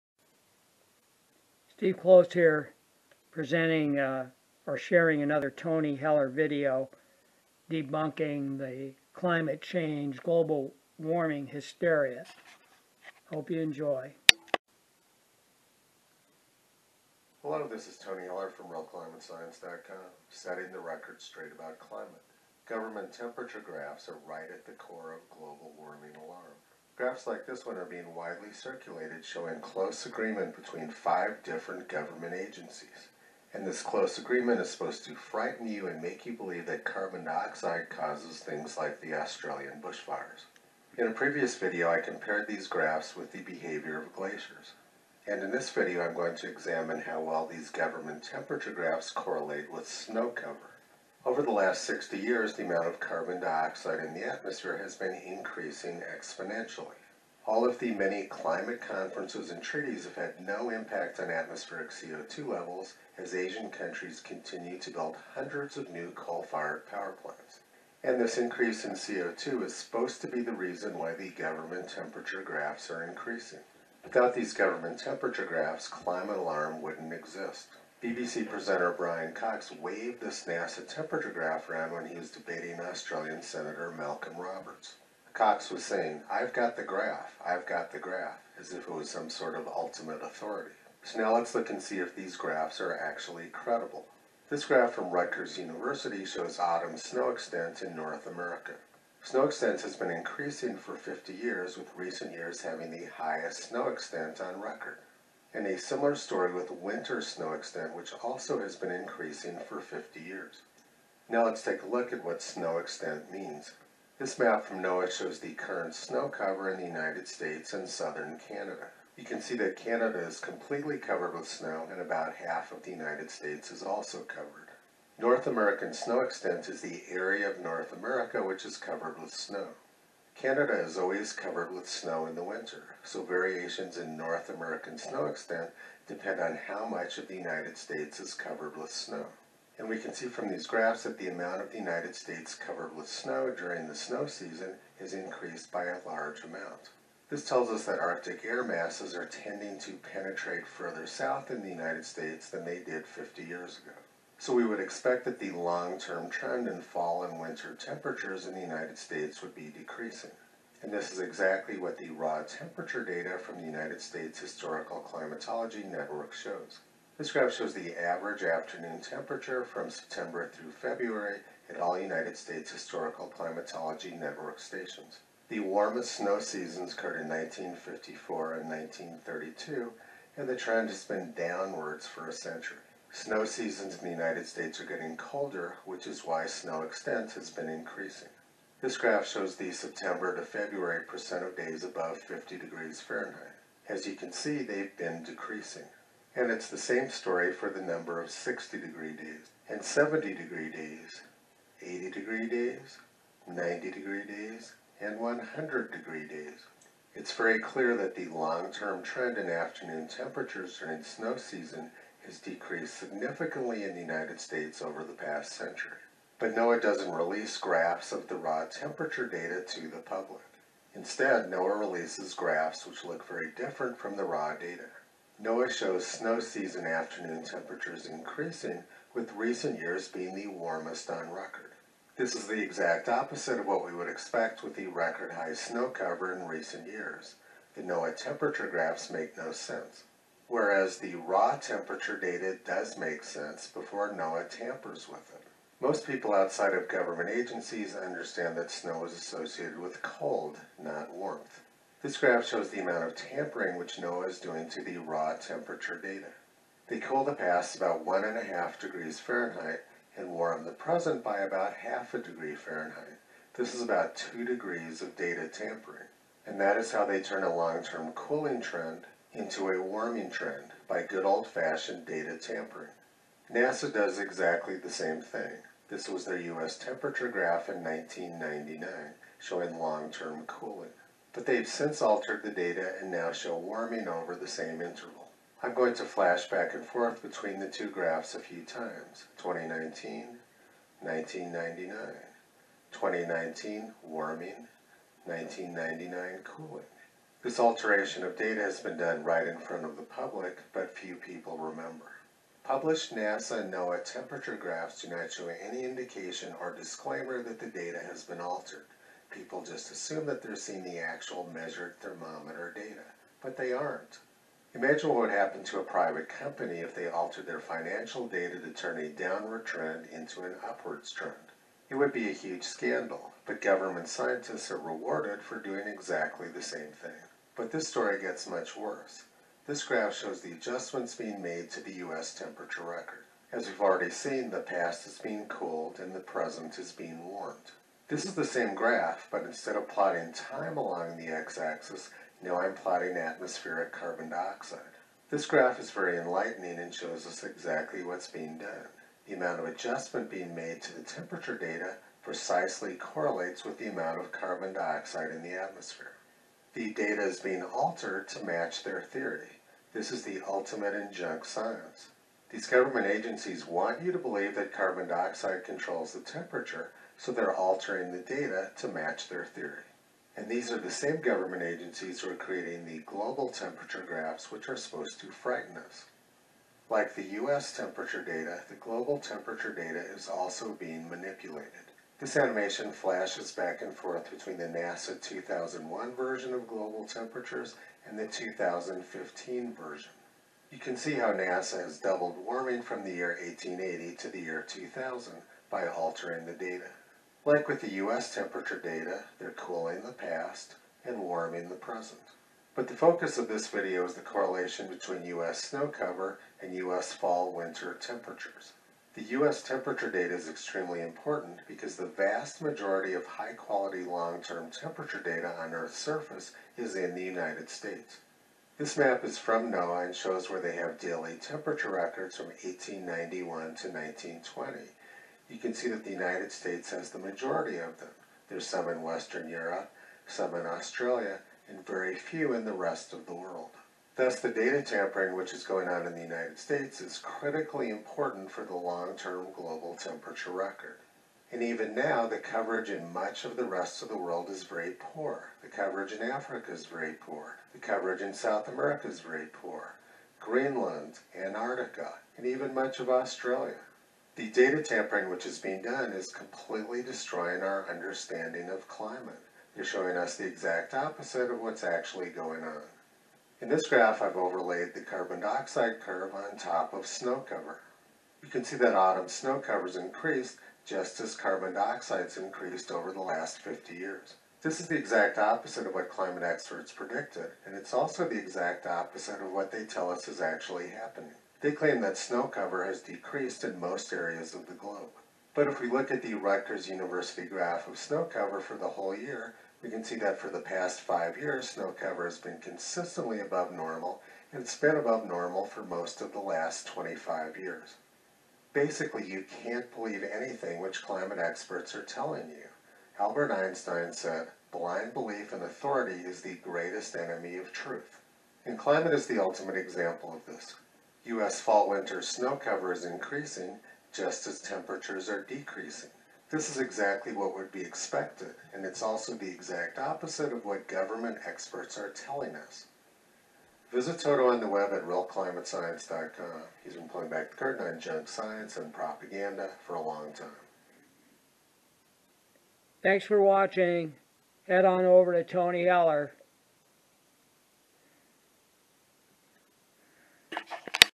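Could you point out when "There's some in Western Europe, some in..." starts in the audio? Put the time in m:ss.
7:08.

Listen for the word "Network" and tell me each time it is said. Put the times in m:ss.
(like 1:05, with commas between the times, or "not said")
2:45, 2:54.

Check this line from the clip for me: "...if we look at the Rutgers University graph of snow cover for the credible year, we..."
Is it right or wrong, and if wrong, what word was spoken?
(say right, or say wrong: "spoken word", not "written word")
wrong: "whole", not "credible".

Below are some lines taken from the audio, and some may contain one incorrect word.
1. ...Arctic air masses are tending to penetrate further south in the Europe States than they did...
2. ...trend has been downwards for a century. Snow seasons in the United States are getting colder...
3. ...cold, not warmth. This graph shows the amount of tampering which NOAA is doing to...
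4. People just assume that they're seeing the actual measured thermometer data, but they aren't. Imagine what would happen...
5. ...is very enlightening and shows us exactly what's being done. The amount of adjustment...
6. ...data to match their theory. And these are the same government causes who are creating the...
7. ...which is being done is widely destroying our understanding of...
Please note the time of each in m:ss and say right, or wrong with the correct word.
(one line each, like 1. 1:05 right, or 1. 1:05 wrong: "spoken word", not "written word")
1. 2:27 wrong: "United", not "Europe"
2. 3:00 right
3. 4:10 right
4. 5:09 right
5. 5:45 right
6. 6:08 wrong: "agencies", not "causes"
7. 7:35 wrong: "completely", not "widely".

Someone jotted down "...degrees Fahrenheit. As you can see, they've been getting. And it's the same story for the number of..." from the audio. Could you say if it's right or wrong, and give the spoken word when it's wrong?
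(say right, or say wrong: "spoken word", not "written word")
wrong: "decreasing", not "getting".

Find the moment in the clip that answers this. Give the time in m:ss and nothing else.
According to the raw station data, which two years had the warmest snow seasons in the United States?
2:57.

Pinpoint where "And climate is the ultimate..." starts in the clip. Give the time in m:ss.
8:28.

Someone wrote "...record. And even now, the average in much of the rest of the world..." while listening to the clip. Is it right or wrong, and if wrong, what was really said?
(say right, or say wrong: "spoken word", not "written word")
wrong: "coverage", not "average".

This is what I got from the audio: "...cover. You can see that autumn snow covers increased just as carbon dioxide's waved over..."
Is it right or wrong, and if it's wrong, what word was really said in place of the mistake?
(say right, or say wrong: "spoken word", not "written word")
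wrong: "increased", not "waved".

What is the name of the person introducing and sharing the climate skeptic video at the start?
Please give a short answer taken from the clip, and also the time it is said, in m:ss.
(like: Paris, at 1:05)
Steve Close, at 0:01.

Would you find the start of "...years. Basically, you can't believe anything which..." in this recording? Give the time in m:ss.
8:17.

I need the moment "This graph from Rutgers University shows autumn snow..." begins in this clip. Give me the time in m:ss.
1:34.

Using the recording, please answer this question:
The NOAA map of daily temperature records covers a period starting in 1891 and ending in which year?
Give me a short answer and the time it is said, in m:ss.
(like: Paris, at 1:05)
1920, at 7:03.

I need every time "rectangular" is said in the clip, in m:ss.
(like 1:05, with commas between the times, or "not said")
not said.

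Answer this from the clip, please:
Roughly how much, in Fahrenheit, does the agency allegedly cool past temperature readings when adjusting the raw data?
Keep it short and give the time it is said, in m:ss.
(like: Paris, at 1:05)
1.5 degrees Fahrenheit, at 4:18.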